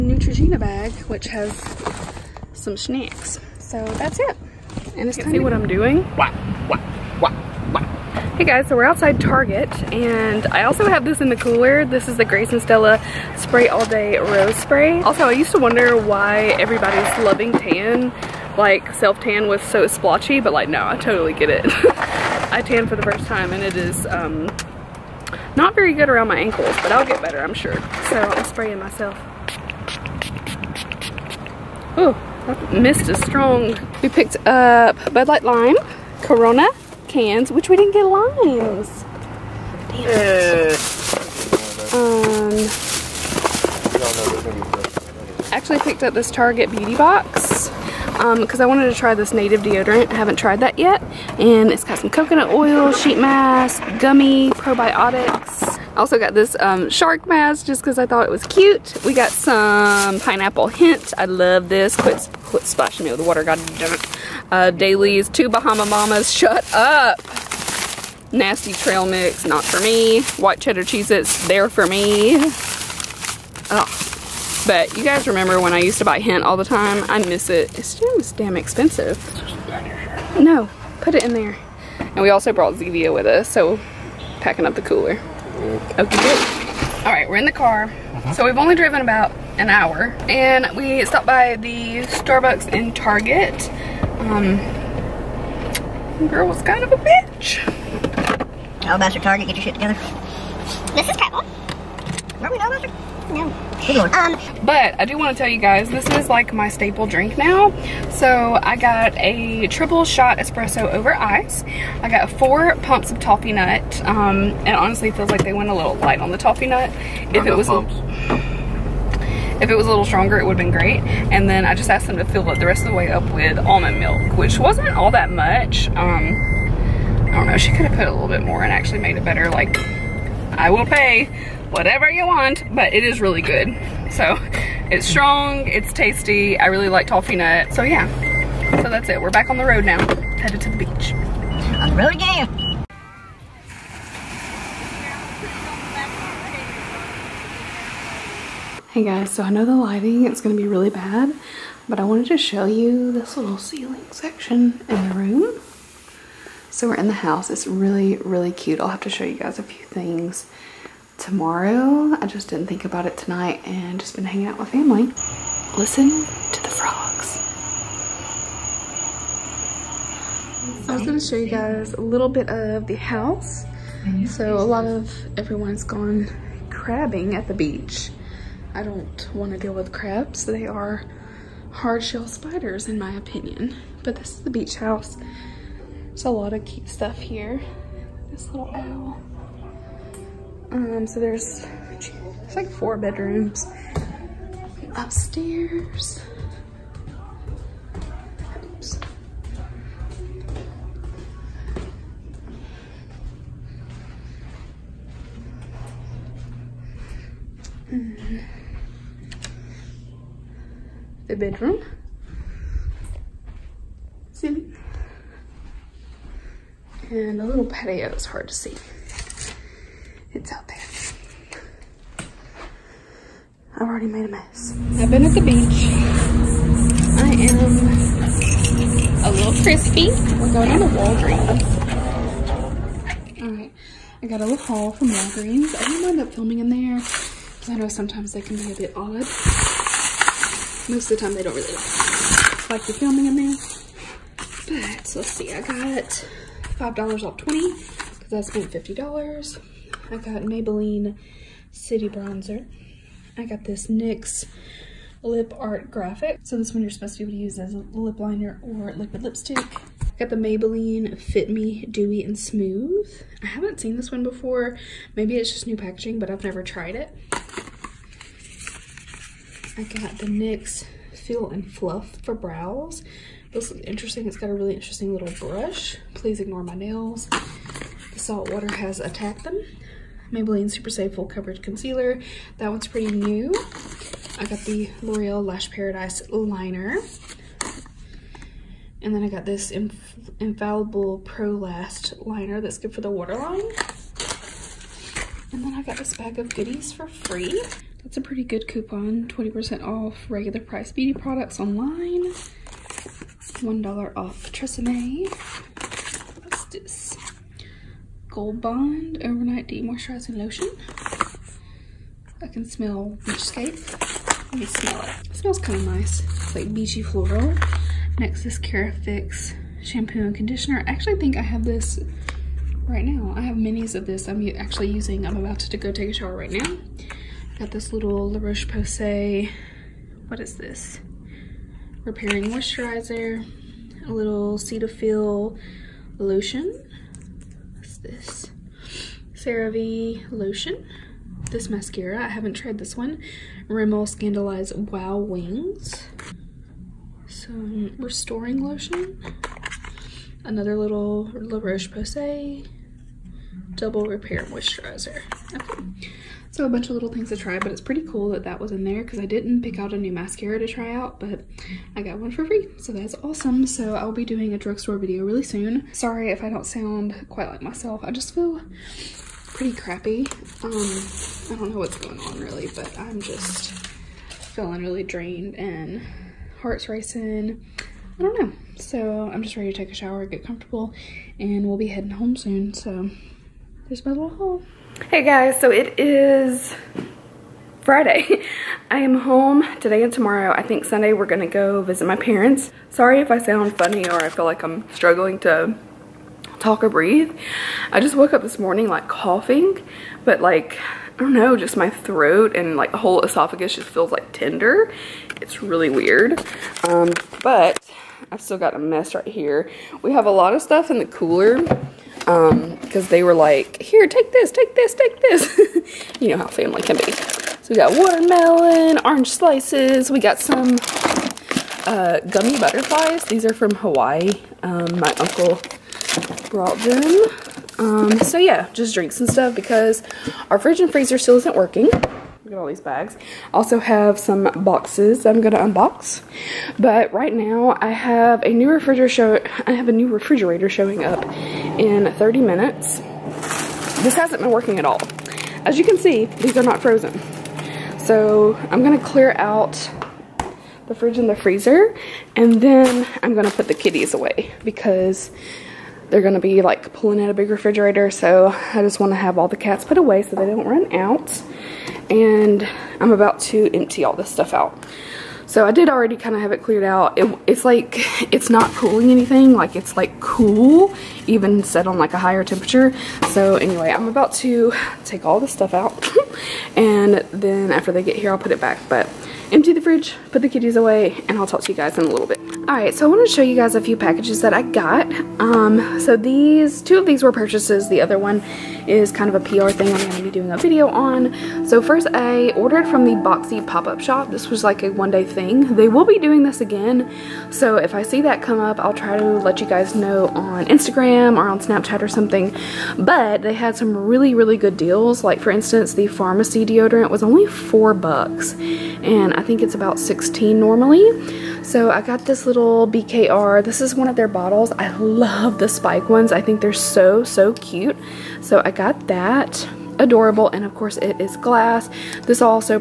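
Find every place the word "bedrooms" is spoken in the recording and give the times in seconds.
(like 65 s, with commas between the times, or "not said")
192 s, 211 s.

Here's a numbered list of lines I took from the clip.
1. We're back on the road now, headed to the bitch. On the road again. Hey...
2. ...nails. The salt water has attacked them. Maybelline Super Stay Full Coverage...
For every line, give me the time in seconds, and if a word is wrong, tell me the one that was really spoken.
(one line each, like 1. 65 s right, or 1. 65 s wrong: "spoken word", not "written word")
1. 139 s wrong: "beach", not "bitch"
2. 276 s right.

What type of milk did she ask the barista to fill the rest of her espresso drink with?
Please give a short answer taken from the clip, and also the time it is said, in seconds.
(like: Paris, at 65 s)
almond milk, at 123 s.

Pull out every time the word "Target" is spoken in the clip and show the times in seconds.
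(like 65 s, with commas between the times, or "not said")
9 s, 46 s, 92 s, 99 s.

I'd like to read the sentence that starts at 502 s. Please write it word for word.
But they had some really, really good deals.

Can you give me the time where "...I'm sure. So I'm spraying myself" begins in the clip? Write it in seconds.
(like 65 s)
27 s.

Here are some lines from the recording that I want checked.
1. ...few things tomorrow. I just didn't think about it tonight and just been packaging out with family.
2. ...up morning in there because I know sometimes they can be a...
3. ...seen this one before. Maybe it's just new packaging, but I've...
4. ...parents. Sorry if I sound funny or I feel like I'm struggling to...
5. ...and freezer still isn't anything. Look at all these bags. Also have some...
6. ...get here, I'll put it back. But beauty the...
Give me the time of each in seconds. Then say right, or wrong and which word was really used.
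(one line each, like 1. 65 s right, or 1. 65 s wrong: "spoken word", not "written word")
1. 159 s wrong: "hanging", not "packaging"
2. 236 s wrong: "filming", not "morning"
3. 263 s right
4. 392 s right
5. 430 s wrong: "working", not "anything"
6. 478 s wrong: "empty", not "beauty".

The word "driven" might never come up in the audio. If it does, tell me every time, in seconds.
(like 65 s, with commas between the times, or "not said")
88 s.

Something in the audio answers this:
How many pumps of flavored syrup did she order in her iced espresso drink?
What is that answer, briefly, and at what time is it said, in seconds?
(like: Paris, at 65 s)
4, at 112 s.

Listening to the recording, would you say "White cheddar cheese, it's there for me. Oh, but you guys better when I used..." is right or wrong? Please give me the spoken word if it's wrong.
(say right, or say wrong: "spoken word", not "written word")
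wrong: "remember", not "better".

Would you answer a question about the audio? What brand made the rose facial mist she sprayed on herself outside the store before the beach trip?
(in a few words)
Grace and Stella.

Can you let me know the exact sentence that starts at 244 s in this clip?
But let's see, I got $5 off 20 because I spent $50.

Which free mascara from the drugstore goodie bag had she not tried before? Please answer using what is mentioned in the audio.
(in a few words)
Rimmel ScandalEyes Wow Wings.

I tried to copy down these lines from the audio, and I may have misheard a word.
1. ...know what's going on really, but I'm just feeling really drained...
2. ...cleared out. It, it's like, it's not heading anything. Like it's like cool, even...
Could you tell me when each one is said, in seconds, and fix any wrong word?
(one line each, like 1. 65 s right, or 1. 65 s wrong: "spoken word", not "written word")
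1. 371 s right
2. 466 s wrong: "cooling", not "heading".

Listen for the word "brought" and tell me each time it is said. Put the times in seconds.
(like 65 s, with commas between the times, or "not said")
82 s, 426 s.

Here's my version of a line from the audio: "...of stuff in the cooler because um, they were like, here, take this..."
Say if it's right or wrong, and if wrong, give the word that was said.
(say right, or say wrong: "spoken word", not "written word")
right.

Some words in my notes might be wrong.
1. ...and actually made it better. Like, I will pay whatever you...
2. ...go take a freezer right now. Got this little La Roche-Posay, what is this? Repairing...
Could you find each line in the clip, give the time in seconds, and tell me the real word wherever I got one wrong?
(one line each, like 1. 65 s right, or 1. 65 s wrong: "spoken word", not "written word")
1. 128 s right
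2. 325 s wrong: "shower", not "freezer".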